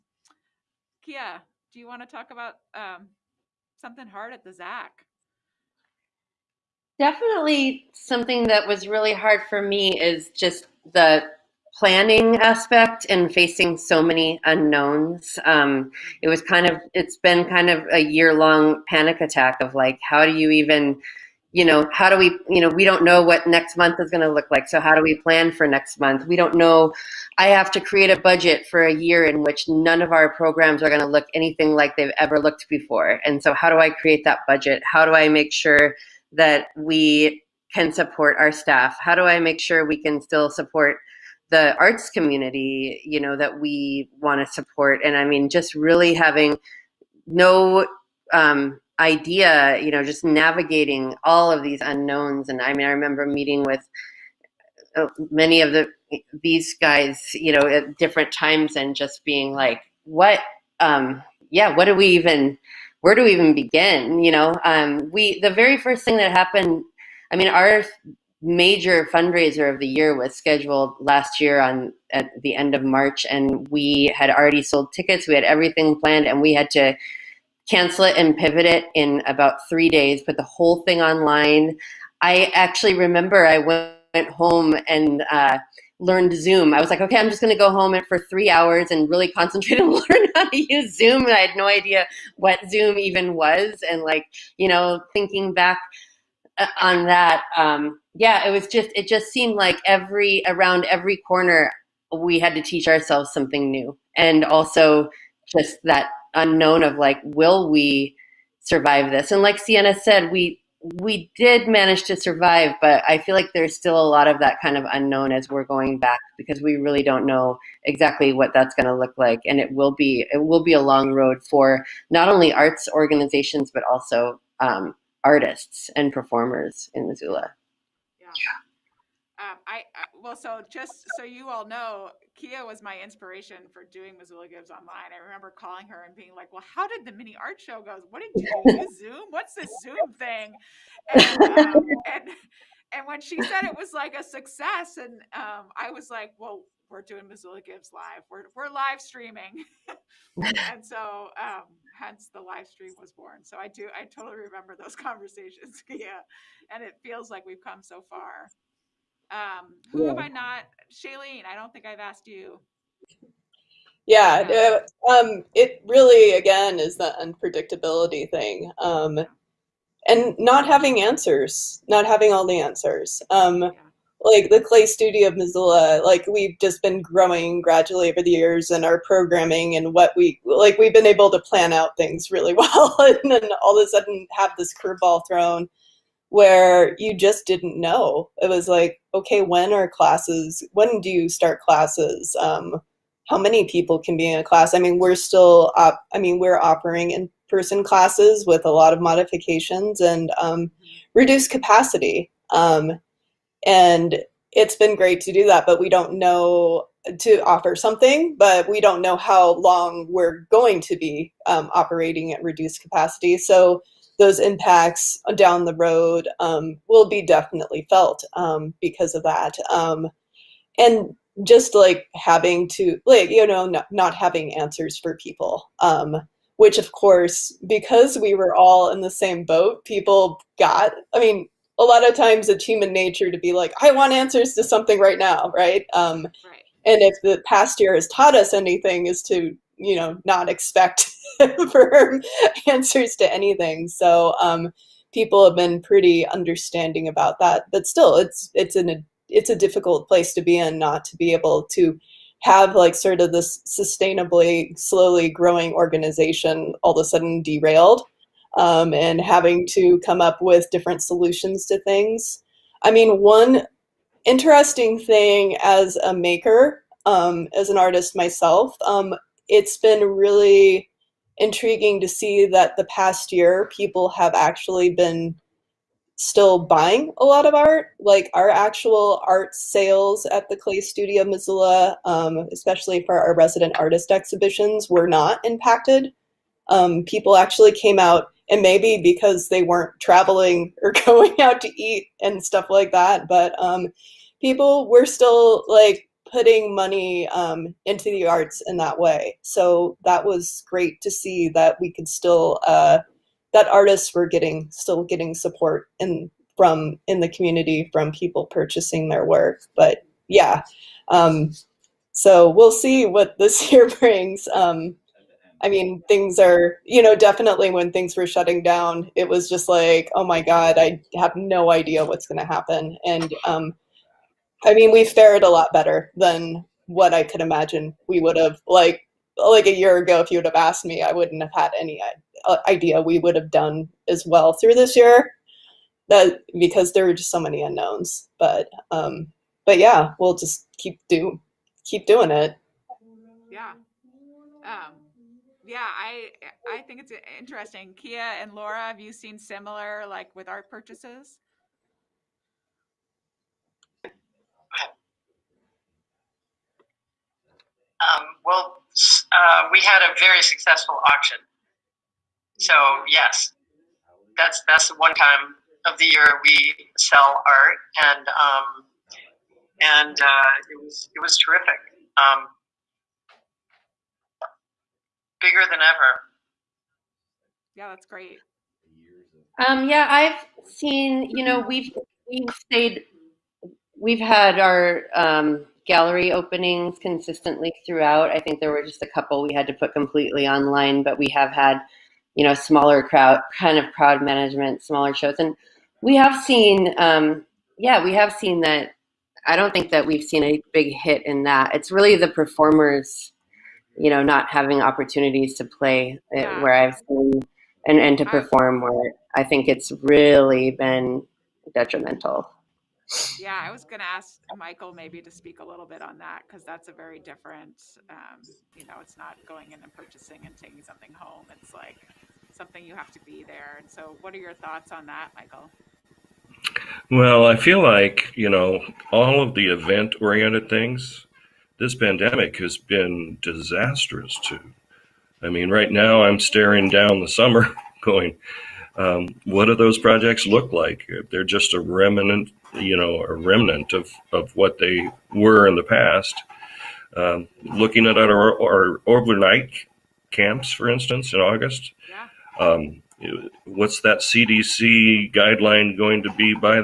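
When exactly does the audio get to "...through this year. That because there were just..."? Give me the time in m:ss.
5:34.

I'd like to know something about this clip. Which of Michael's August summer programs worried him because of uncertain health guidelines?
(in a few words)
overnight camps.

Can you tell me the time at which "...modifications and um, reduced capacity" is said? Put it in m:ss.
3:19.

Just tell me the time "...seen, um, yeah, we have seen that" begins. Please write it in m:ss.
6:36.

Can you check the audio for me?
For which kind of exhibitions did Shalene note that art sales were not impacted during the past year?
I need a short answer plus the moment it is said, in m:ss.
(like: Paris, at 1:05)
resident artist exhibitions, at 4:43.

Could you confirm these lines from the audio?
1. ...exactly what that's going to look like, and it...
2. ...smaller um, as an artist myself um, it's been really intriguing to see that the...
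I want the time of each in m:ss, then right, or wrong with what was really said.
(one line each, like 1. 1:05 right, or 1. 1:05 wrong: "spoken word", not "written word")
1. 1:57 right
2. 4:26 wrong: "maker", not "smaller".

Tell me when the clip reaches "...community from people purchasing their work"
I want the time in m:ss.
5:07.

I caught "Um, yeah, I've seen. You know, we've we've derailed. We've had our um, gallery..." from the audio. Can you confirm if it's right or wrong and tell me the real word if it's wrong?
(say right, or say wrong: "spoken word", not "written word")
wrong: "stayed", not "derailed".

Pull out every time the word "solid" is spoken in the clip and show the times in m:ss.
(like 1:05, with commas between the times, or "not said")
not said.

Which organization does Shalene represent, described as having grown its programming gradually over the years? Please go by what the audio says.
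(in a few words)
Clay Studio of Missoula.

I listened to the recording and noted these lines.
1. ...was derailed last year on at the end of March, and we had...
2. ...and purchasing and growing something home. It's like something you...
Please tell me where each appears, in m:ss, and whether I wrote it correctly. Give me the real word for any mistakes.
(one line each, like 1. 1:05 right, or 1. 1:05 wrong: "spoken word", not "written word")
1. 1:10 wrong: "scheduled", not "derailed"
2. 6:59 wrong: "taking", not "growing".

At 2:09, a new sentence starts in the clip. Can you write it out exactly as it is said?
Um, I, I well, so just so you all know, Kia was my inspiration for doing Missoula Gives online.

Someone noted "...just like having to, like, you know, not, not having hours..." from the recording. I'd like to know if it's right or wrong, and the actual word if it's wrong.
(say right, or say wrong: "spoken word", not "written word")
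wrong: "answers", not "hours".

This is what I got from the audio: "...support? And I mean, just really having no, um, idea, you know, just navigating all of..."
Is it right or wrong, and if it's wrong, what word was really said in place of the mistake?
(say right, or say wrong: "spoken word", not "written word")
right.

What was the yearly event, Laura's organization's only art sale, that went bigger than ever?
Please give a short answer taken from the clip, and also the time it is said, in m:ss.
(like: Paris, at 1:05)
auction, at 6:01.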